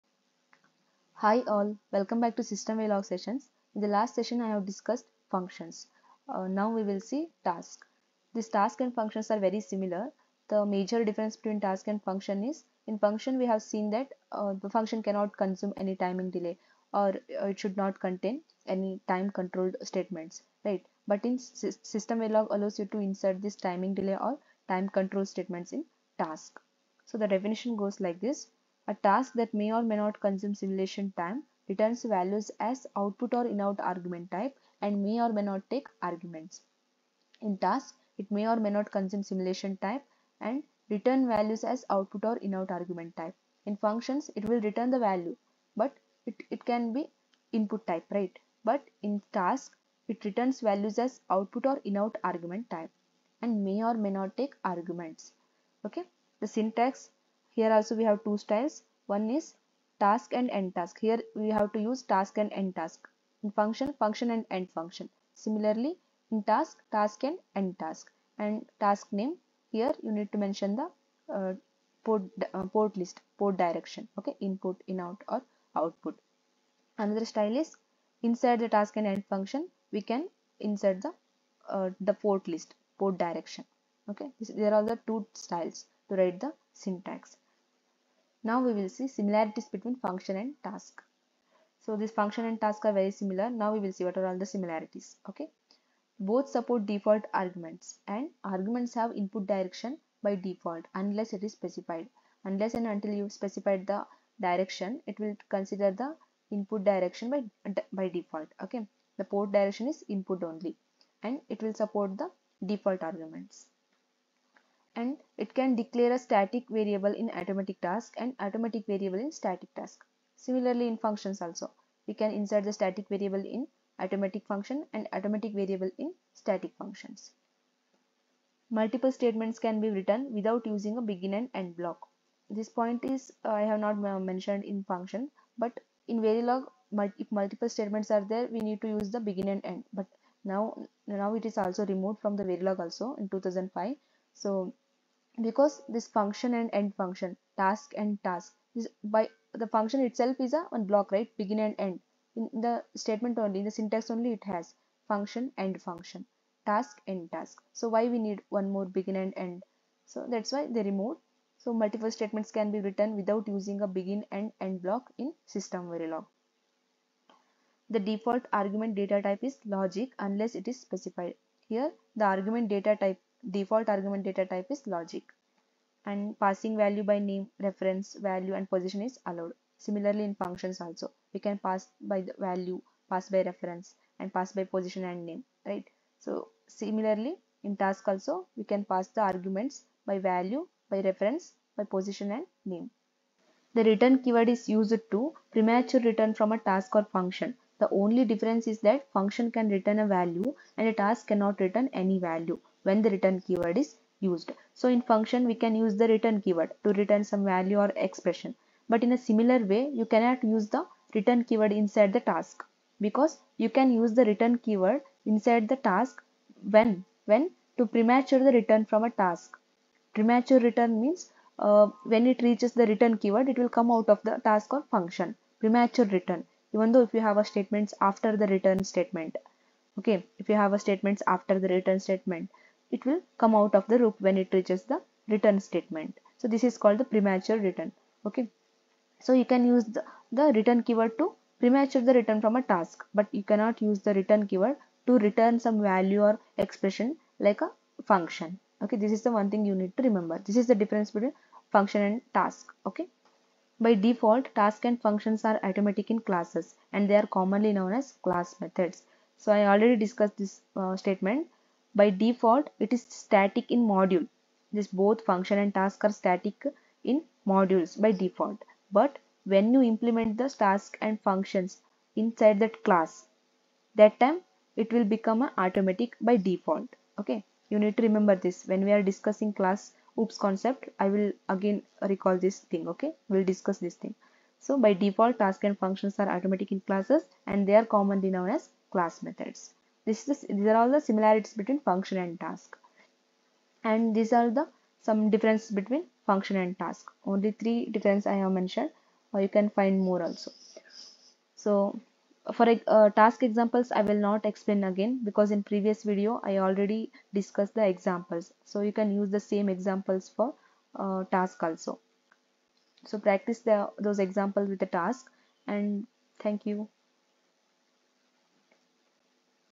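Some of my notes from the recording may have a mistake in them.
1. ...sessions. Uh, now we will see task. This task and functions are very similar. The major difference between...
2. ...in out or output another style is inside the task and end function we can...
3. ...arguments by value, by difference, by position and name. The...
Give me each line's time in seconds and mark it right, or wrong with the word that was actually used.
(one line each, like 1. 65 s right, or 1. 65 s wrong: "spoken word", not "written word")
1. 5 s wrong: "functions", not "sessions"
2. 74 s right
3. 189 s wrong: "reference", not "difference".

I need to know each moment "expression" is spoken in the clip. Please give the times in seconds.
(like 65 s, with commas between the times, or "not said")
207 s, 246 s.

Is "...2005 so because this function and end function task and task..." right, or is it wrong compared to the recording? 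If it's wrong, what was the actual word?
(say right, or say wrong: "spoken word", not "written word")
right.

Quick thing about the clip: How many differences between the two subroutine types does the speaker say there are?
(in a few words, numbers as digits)
3.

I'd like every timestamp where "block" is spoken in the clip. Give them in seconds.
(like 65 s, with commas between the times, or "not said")
131 s, 150 s, 164 s.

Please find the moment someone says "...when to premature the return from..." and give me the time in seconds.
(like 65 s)
217 s.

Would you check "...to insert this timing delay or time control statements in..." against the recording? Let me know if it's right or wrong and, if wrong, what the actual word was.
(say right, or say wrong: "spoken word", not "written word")
right.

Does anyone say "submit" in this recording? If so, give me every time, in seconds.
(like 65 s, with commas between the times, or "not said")
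not said.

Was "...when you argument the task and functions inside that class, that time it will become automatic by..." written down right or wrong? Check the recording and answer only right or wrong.
wrong.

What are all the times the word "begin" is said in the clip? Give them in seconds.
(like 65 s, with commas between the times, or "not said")
131 s, 139 s, 151 s, 158 s, 163 s.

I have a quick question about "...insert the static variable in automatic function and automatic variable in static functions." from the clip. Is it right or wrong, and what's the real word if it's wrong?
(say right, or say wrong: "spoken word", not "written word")
right.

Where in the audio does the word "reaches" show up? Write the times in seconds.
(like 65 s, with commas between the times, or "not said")
222 s, 234 s.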